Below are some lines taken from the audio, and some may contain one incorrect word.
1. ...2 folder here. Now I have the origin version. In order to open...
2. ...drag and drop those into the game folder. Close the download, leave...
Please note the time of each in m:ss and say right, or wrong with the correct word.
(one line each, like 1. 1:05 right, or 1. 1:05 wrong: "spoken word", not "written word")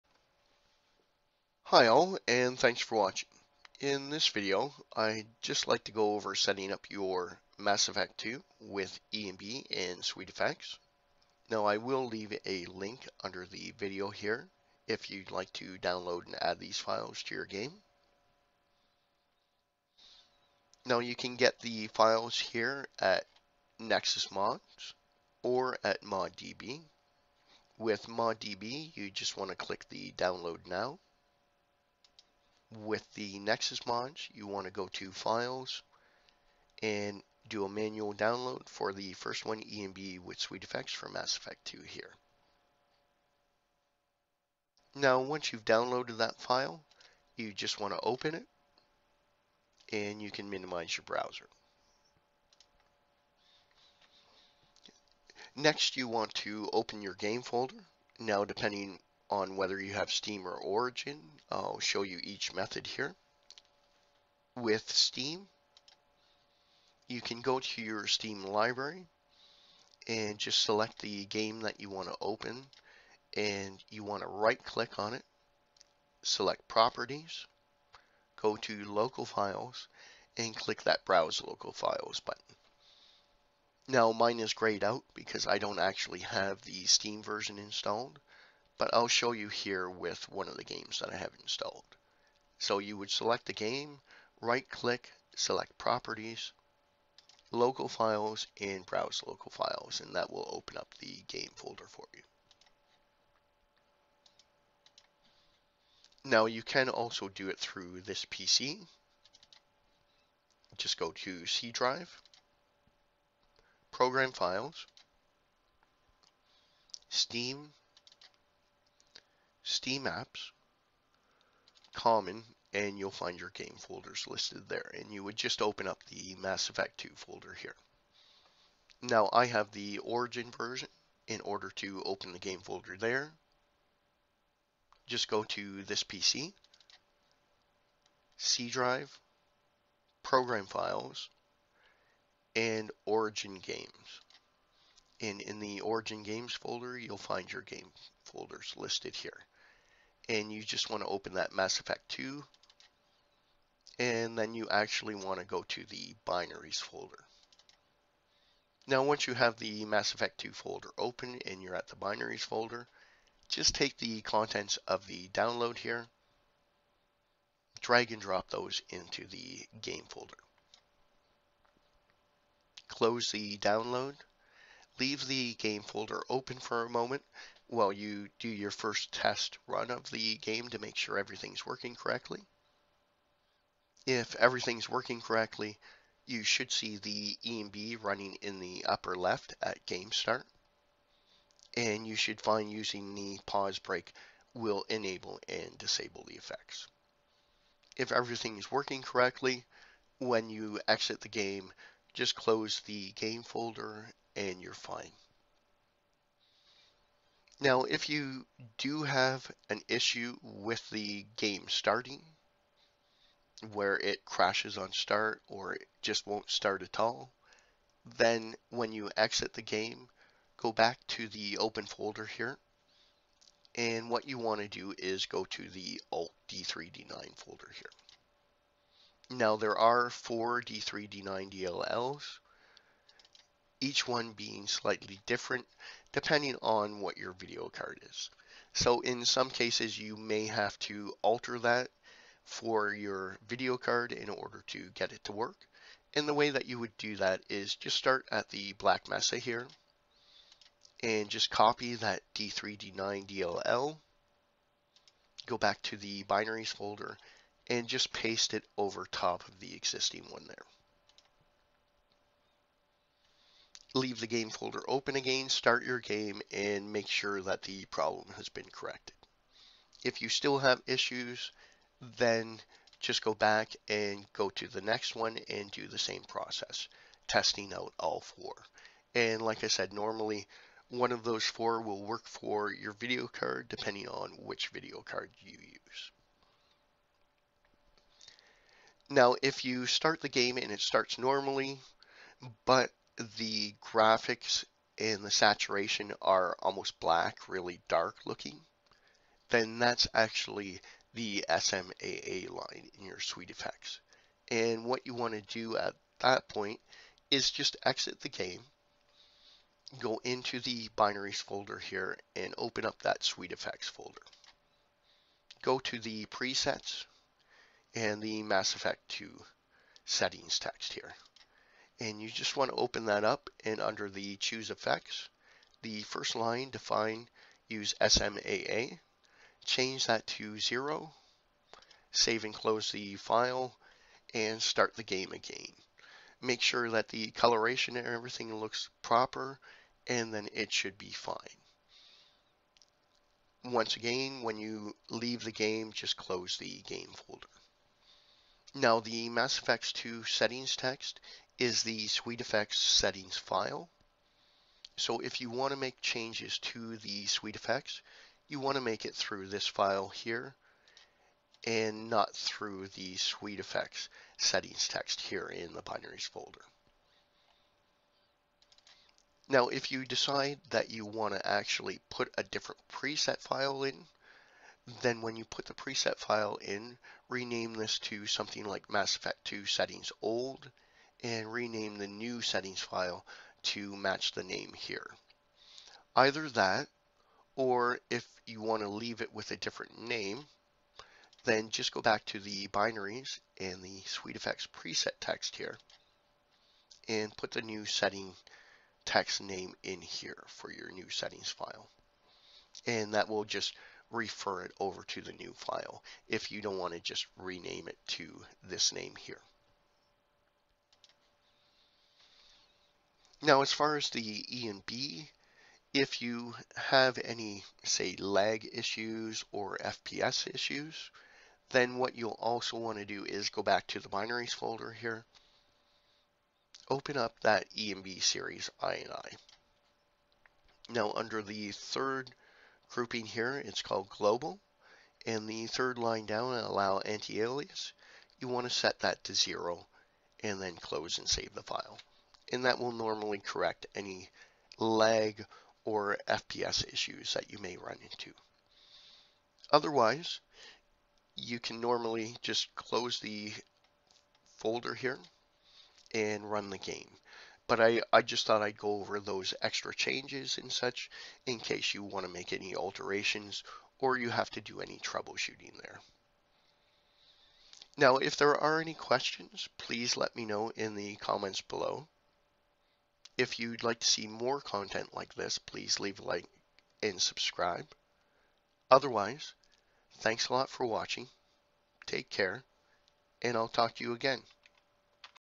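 1. 2:06 right
2. 2:47 right.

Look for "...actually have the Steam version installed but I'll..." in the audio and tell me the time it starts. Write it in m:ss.
1:25.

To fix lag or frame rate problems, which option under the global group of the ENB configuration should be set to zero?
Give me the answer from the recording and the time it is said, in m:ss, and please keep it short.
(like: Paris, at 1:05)
allow anti-alias, at 7:16.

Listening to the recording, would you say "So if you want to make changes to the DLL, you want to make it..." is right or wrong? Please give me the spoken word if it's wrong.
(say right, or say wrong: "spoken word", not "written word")
wrong: "SweetFX", not "DLL".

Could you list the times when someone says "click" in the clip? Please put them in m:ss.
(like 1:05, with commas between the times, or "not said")
0:29, 1:14, 1:20, 1:34.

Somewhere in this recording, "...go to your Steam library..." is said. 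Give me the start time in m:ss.
1:07.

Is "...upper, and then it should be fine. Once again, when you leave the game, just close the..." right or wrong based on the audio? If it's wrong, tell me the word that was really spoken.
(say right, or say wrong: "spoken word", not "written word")
wrong: "proper", not "upper".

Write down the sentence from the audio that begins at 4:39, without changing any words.
And like I said, normally one of those four will work for your video card depending on which video card you use.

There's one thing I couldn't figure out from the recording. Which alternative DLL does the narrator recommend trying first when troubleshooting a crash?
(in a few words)
Black Mesa.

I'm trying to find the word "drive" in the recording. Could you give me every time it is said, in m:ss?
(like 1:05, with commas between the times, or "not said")
1:51, 2:18.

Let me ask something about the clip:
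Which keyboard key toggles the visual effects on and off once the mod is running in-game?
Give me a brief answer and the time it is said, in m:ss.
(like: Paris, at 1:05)
Pause Break, at 3:13.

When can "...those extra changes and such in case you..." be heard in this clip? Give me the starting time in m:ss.
7:39.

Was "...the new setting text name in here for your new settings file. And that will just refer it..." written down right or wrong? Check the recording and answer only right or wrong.
right.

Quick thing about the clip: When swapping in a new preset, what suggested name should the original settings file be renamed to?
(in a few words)
Mass Effect 2 settings old.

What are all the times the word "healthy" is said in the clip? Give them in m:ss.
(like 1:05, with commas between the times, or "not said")
not said.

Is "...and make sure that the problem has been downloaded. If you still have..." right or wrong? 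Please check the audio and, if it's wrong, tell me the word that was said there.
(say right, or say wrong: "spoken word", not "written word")
wrong: "corrected", not "downloaded".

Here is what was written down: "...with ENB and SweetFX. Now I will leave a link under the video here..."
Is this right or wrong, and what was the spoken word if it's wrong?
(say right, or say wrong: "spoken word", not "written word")
right.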